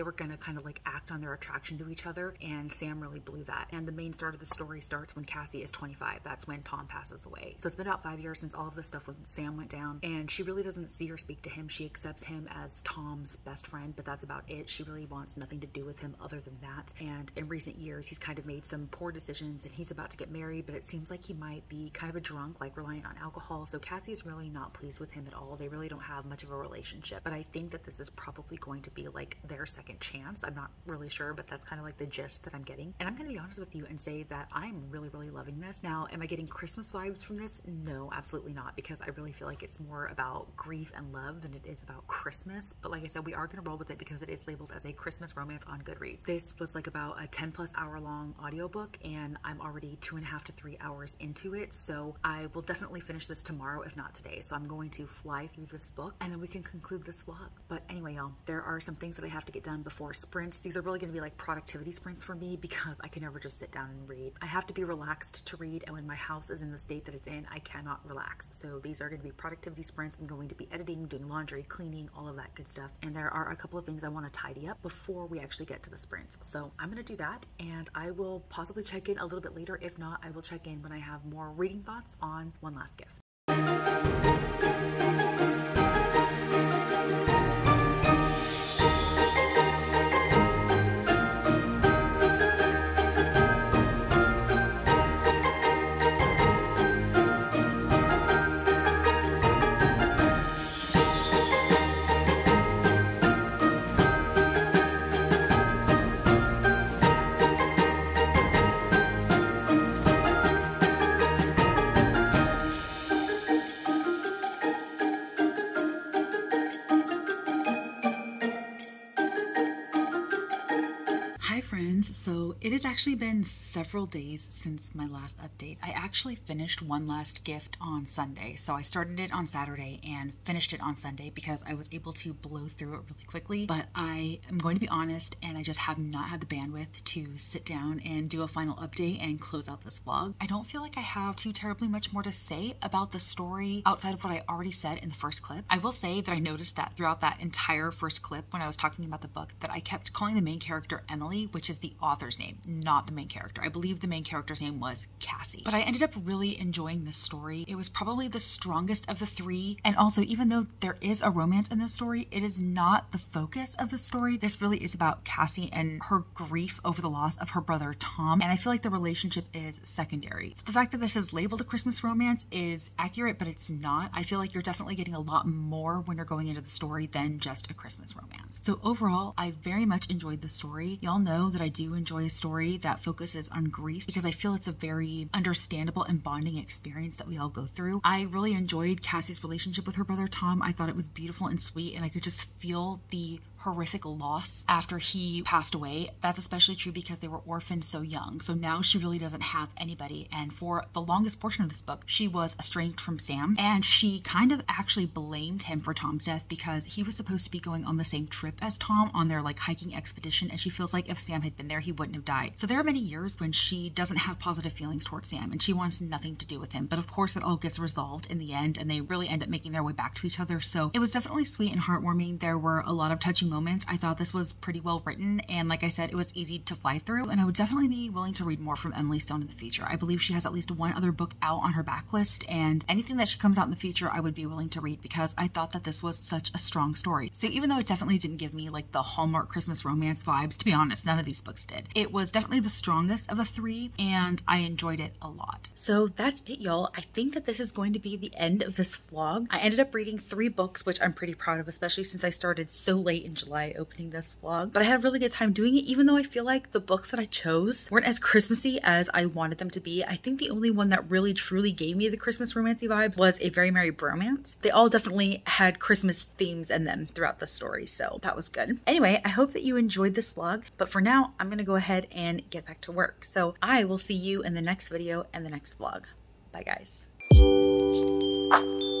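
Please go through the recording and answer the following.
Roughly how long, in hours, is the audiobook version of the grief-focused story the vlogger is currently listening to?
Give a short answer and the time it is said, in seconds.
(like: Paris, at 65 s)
10 plus hours, at 47 s.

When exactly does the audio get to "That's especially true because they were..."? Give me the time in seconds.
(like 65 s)
196 s.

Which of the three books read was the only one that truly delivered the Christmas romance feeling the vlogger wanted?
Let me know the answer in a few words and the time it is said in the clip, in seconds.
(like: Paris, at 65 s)
A Very Merry Bromance, at 263 s.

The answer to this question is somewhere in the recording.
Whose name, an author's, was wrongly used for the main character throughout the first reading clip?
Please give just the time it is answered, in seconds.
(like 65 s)
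228 s.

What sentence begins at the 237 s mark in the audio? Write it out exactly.
So even though it definitely didn't give me like the Hallmark Christmas romance vibes, to be honest, none of these books did.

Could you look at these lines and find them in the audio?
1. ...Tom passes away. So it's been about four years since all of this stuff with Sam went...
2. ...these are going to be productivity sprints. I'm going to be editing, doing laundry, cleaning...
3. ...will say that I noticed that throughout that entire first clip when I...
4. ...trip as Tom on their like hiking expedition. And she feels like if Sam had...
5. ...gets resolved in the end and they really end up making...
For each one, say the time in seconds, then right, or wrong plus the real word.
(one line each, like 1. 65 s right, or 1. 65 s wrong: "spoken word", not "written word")
1. 6 s wrong: "five", not "four"
2. 68 s right
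3. 145 s right
4. 208 s right
5. 217 s right.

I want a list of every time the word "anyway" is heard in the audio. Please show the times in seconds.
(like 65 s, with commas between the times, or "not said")
57 s, 268 s.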